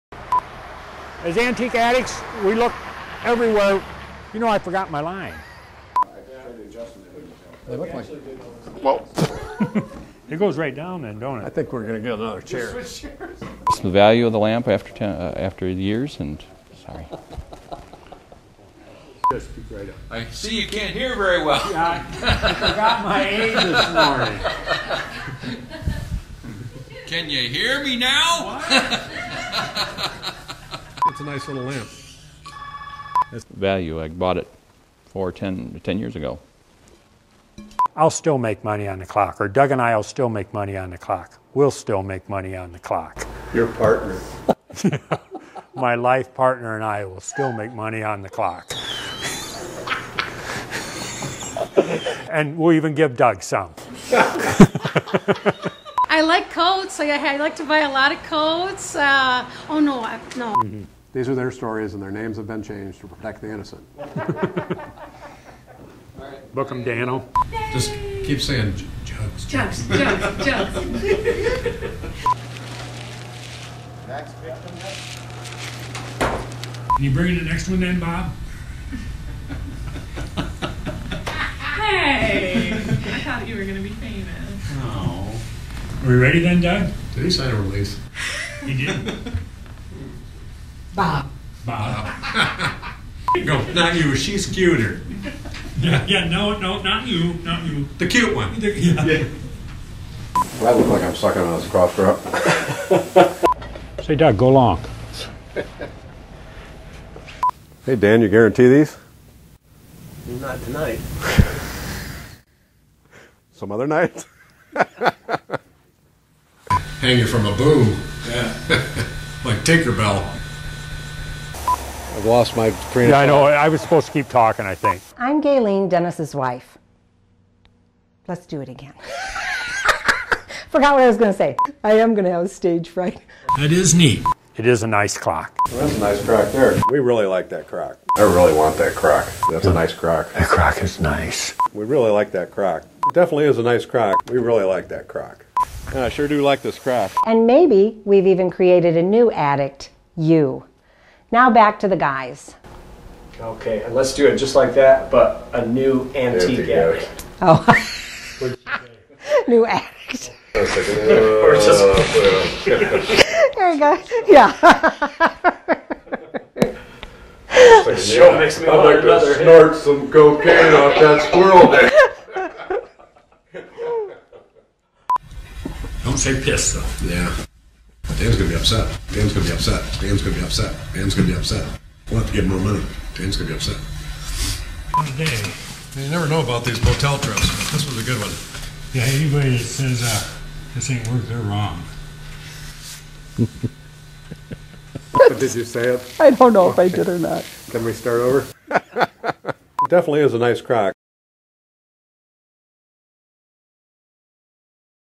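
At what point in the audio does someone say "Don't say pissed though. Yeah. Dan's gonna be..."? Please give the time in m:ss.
2:56.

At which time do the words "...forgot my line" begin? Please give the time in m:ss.
0:04.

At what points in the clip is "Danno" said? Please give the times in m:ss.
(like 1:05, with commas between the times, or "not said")
1:06.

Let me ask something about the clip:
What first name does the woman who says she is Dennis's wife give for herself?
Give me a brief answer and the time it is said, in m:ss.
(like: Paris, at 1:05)
Gaylene, at 2:05.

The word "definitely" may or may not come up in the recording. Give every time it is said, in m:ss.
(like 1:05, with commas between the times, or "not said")
2:23, 3:19.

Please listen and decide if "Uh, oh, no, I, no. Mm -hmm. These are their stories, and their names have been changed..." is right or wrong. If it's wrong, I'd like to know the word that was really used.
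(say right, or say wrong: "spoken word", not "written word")
right.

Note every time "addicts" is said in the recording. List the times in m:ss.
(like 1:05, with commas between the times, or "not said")
0:01, 2:29.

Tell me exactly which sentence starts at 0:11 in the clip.
I think we're going to get another chair.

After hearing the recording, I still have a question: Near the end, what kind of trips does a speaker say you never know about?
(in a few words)
Motel trips.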